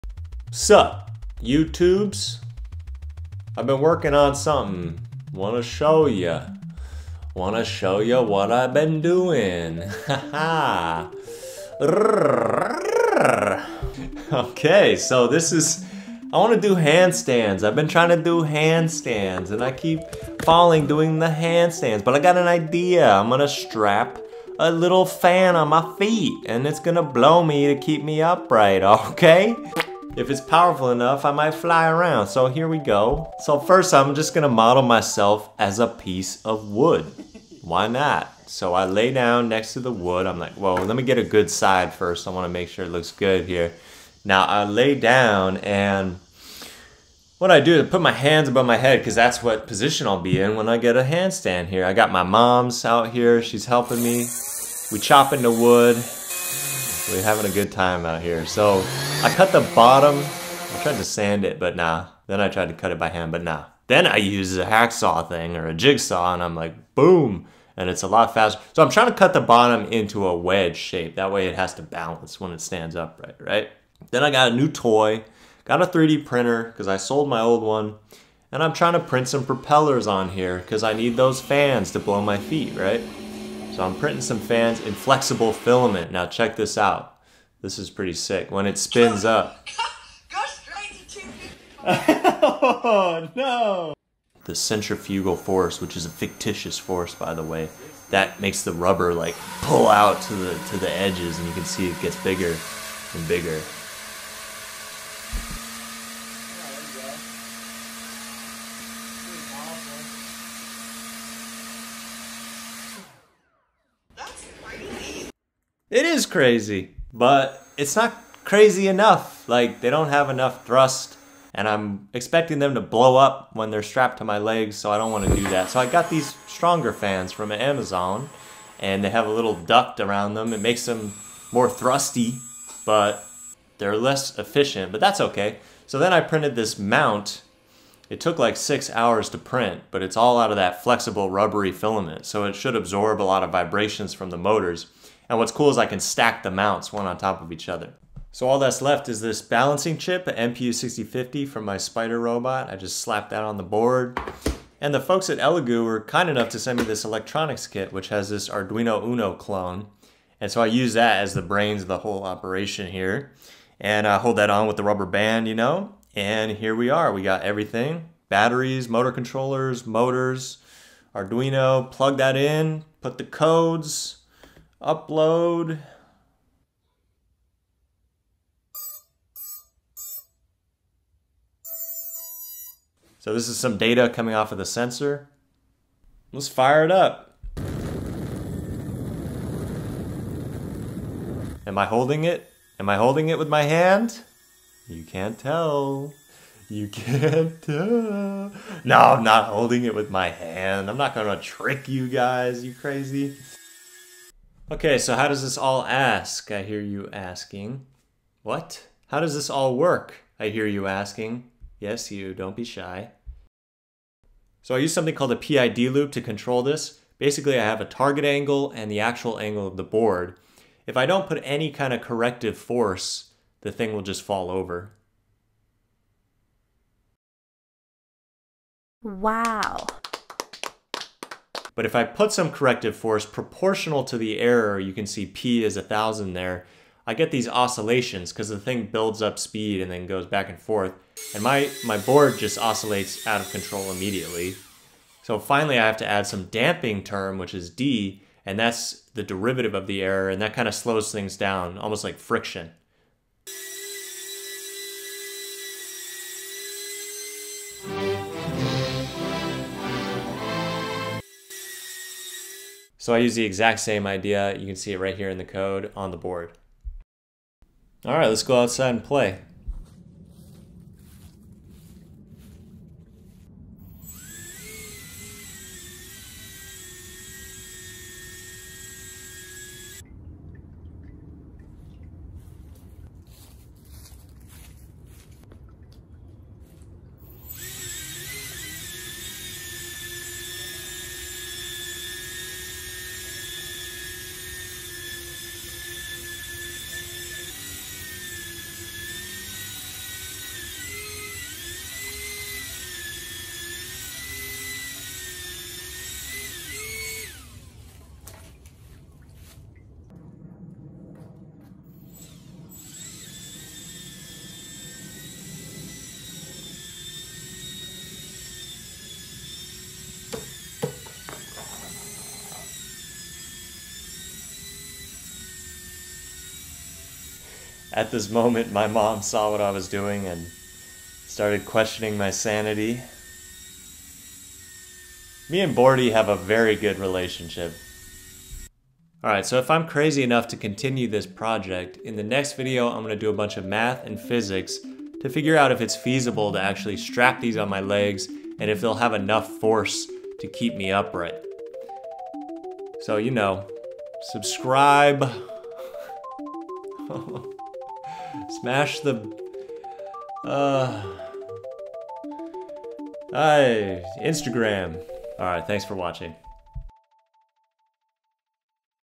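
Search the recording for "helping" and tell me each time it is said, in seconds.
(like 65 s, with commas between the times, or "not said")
53 s.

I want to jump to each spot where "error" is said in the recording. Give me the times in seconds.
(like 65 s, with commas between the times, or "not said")
234 s, 250 s.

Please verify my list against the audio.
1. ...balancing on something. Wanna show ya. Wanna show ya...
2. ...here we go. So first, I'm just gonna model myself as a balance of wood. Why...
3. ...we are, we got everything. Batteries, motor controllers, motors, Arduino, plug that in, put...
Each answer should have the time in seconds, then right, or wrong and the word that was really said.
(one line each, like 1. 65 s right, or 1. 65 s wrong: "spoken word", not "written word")
1. 3 s wrong: "working", not "balancing"
2. 32 s wrong: "piece", not "balance"
3. 166 s right.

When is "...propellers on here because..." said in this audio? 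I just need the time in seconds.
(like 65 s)
79 s.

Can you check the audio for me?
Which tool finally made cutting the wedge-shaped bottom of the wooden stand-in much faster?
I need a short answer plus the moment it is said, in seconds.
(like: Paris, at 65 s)
jigsaw, at 65 s.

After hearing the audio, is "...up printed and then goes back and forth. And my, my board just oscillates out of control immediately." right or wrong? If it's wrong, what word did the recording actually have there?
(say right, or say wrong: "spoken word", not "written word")
wrong: "speed", not "printed".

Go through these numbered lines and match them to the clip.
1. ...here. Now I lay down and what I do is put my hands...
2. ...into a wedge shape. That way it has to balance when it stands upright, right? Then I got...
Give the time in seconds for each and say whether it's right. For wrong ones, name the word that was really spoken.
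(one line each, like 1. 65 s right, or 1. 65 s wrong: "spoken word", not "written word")
1. 43 s right
2. 69 s right.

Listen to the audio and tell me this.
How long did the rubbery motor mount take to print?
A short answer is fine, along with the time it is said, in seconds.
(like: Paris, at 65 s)
six hours, at 138 s.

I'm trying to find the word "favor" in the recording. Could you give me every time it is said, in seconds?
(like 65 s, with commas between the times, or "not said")
not said.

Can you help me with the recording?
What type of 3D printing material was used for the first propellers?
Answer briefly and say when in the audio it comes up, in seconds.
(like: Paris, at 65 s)
flexible filament, at 84 s.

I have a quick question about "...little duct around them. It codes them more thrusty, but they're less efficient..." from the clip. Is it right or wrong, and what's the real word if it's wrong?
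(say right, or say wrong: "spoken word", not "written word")
wrong: "makes", not "codes".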